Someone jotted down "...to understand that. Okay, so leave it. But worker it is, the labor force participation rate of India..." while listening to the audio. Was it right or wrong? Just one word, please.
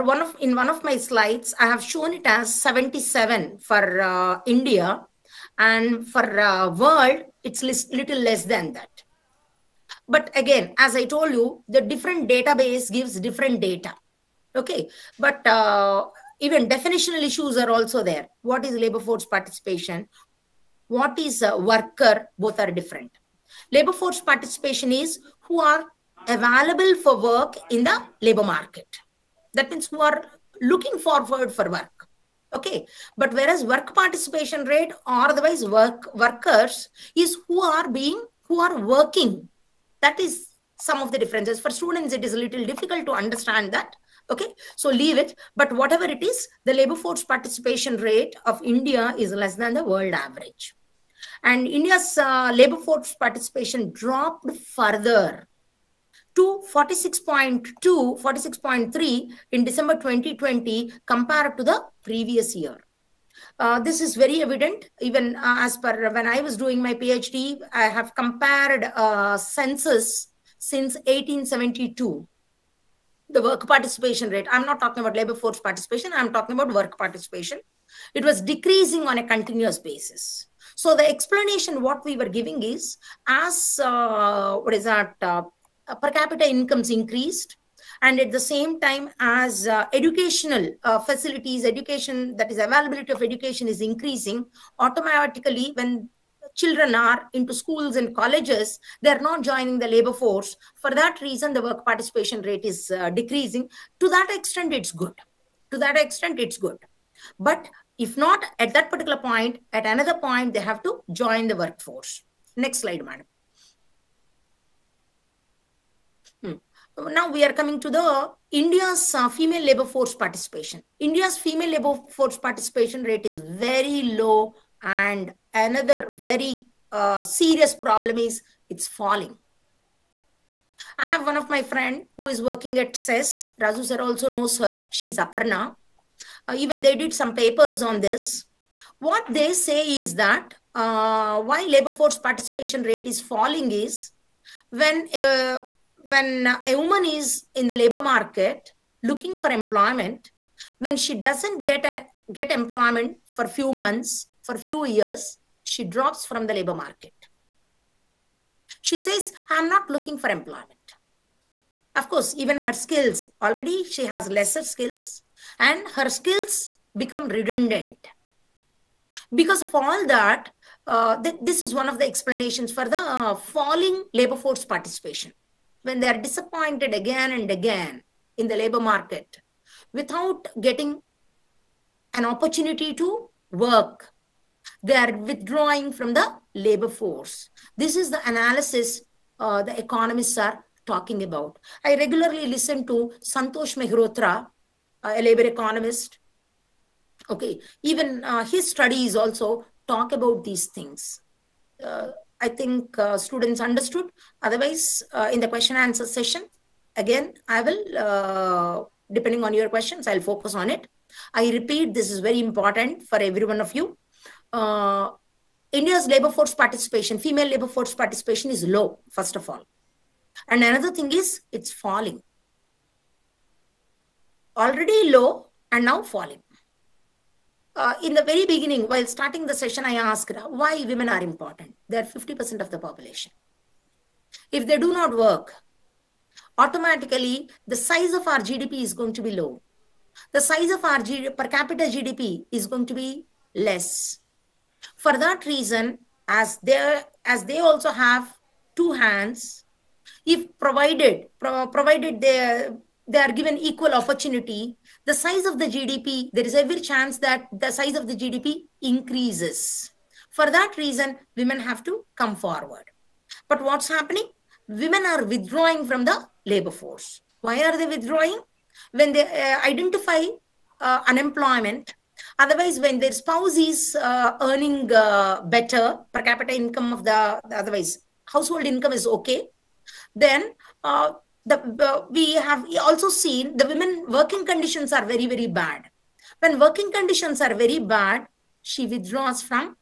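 wrong.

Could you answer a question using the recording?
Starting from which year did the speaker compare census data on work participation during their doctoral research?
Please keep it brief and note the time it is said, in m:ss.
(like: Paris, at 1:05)
1872, at 1:10.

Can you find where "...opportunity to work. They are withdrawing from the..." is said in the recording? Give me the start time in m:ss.
3:02.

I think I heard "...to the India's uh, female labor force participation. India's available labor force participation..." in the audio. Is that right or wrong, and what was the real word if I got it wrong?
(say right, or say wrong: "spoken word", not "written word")
wrong: "female", not "available".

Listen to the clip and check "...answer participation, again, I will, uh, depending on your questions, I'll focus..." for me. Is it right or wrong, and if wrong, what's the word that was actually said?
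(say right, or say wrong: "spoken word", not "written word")
wrong: "session", not "participation".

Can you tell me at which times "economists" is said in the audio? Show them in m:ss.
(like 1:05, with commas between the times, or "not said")
3:09, 3:15.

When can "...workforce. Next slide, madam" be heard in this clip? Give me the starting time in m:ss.
1:51.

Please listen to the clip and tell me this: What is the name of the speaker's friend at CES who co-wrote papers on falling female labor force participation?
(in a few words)
Aparna.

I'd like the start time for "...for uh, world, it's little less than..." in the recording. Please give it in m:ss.
0:06.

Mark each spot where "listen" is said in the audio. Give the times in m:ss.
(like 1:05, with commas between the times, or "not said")
3:12.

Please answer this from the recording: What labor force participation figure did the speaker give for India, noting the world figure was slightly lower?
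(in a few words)
77.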